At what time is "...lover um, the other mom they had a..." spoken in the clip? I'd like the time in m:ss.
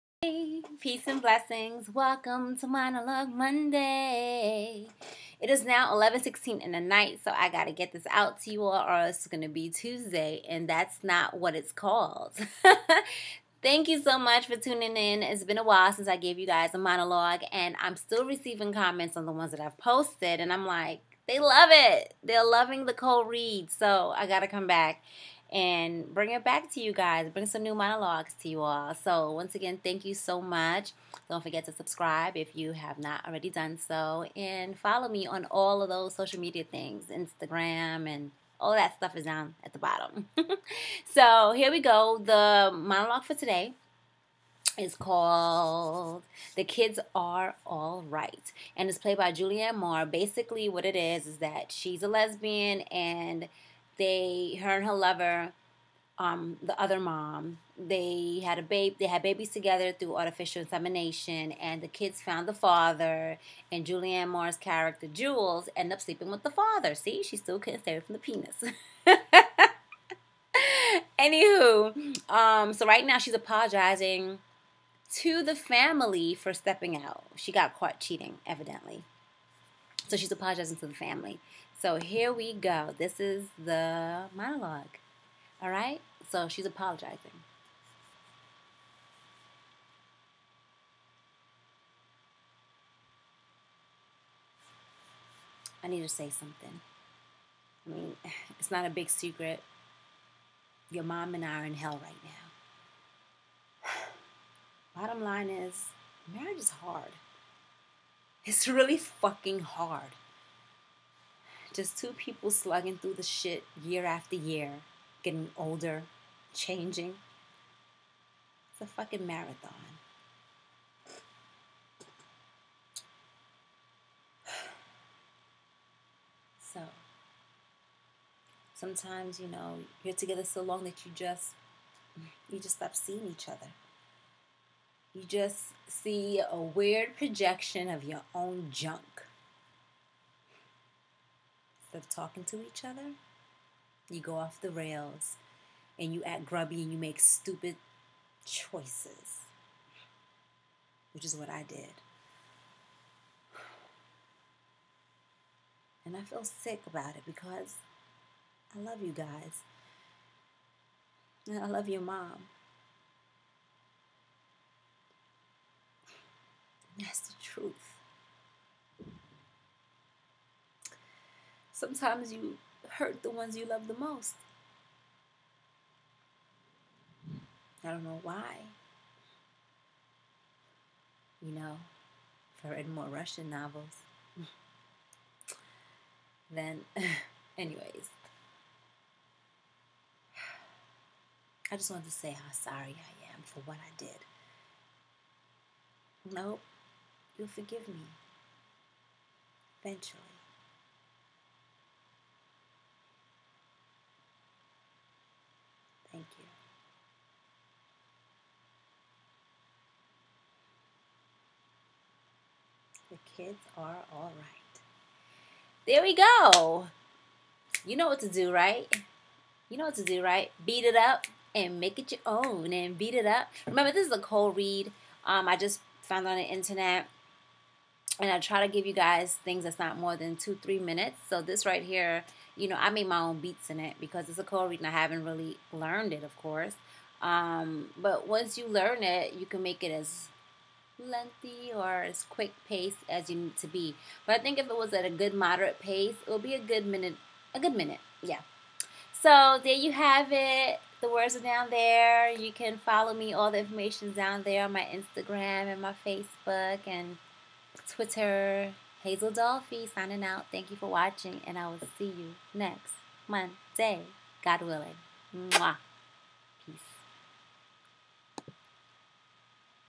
0:54.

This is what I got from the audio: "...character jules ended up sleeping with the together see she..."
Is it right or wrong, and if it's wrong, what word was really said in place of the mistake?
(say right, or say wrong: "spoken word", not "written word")
wrong: "father", not "together".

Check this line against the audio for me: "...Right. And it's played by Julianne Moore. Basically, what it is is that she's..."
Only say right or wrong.
right.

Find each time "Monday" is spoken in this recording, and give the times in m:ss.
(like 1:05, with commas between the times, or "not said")
0:03, 4:23.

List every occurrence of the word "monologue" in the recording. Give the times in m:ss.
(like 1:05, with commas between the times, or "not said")
0:02, 0:16, 0:27, 0:42, 1:24.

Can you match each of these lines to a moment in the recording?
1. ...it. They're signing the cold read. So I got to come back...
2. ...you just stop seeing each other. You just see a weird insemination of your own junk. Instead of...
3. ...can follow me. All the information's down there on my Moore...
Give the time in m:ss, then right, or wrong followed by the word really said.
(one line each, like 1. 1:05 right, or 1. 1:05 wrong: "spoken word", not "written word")
1. 0:21 wrong: "loving", not "signing"
2. 2:12 wrong: "projection", not "insemination"
3. 4:12 wrong: "Instagram", not "Moore".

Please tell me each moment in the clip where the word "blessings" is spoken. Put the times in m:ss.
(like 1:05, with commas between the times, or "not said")
0:01.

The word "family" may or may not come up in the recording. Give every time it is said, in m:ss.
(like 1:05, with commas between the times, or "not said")
1:15, 1:20.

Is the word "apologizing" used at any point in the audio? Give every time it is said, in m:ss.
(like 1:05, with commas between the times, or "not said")
1:13, 1:20, 1:26.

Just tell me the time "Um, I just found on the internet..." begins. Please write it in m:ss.
3:45.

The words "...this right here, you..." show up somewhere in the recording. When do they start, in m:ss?
3:51.